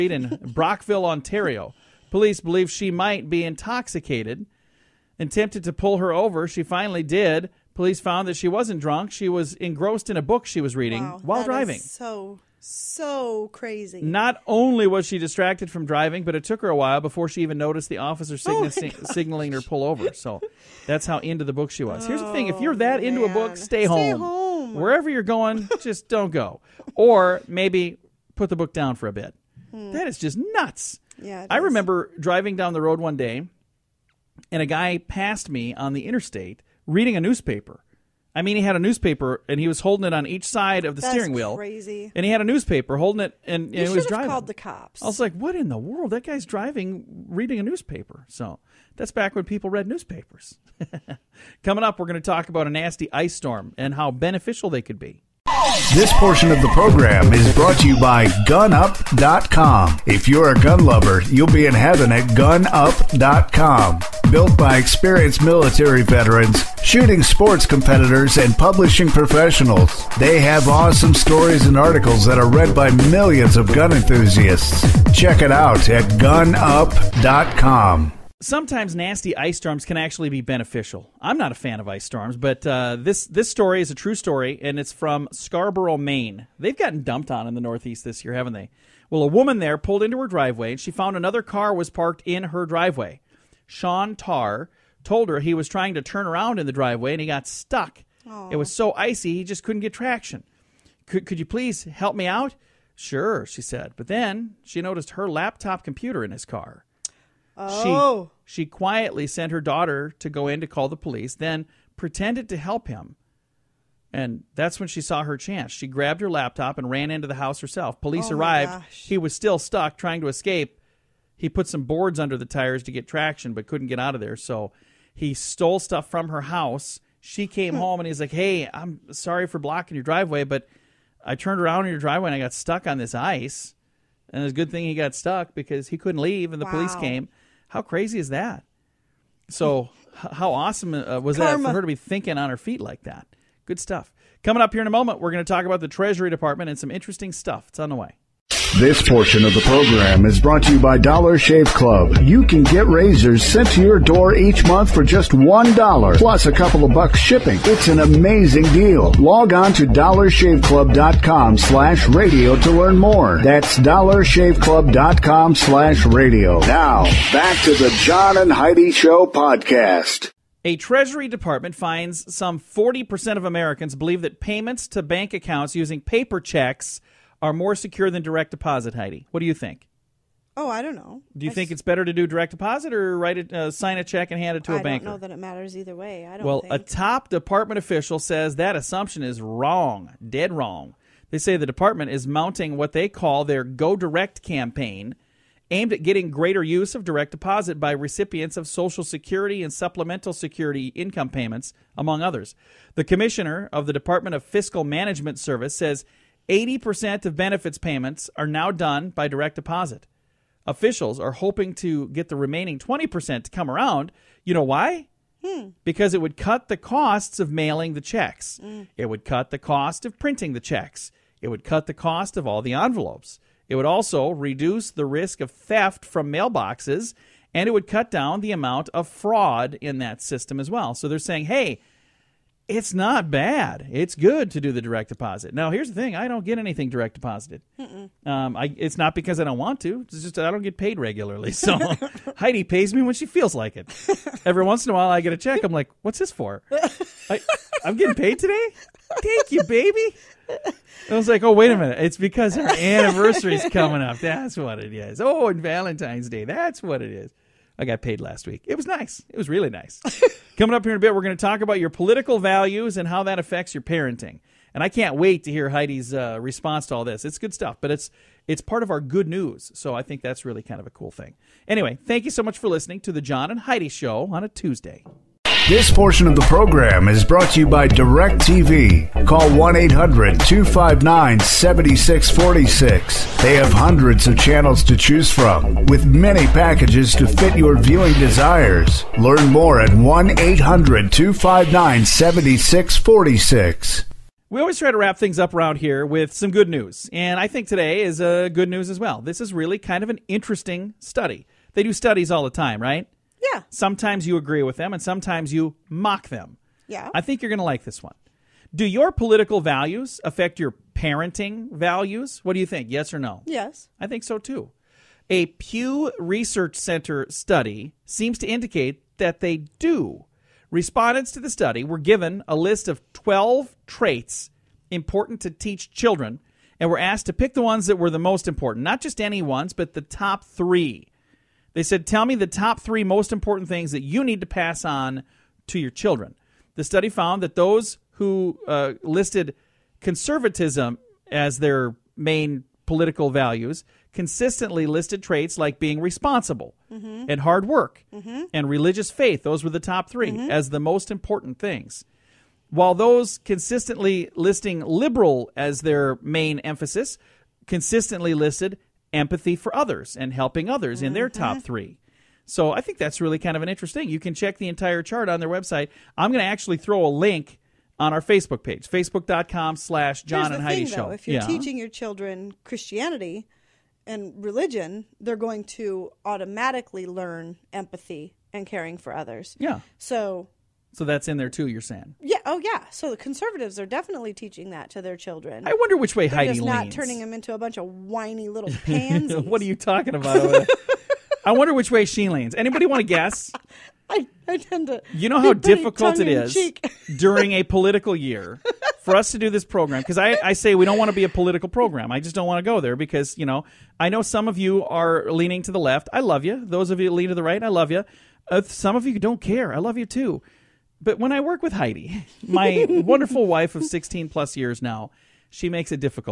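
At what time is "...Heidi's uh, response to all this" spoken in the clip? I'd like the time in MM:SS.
04:25.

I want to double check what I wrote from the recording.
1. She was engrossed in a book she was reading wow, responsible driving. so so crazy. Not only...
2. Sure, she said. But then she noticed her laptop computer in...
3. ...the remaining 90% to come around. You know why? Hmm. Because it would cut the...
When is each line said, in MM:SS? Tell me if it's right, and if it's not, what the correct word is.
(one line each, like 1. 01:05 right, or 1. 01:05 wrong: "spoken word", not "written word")
1. 00:09 wrong: "while", not "responsible"
2. 01:42 right
3. 03:32 wrong: "20", not "90".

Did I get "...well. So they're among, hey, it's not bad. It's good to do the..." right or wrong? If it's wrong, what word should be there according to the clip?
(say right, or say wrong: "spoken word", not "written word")
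wrong: "saying", not "among".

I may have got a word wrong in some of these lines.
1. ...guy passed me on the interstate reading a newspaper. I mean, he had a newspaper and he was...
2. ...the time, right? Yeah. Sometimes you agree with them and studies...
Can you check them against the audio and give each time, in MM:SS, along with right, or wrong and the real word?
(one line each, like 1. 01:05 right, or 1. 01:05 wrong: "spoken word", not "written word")
1. 00:34 right
2. 05:02 wrong: "sometimes", not "studies".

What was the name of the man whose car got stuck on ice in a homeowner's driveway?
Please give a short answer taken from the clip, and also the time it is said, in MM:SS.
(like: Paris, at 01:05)
Sean Tarr, at 01:33.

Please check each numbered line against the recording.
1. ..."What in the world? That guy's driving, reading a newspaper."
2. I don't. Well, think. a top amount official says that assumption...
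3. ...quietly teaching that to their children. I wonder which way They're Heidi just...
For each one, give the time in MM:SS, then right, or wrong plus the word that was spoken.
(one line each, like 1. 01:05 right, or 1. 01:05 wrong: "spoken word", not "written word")
1. 00:45 right
2. 03:06 wrong: "department", not "amount"
3. 06:23 wrong: "definitely", not "quietly".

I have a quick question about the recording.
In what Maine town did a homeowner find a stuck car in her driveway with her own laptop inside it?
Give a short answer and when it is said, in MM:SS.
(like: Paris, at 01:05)
Scarborough, at 01:25.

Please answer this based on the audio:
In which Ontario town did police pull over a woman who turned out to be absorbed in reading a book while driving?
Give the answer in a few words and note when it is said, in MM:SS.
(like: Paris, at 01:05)
Brockville, at 00:00.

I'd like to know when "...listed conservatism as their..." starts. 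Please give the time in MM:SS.
05:39.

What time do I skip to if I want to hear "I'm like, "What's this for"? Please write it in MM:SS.
04:05.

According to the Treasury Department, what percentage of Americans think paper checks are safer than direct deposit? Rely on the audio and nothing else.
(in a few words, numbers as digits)
40%.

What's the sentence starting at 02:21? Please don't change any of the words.
that for her to be thinking on her feet like that?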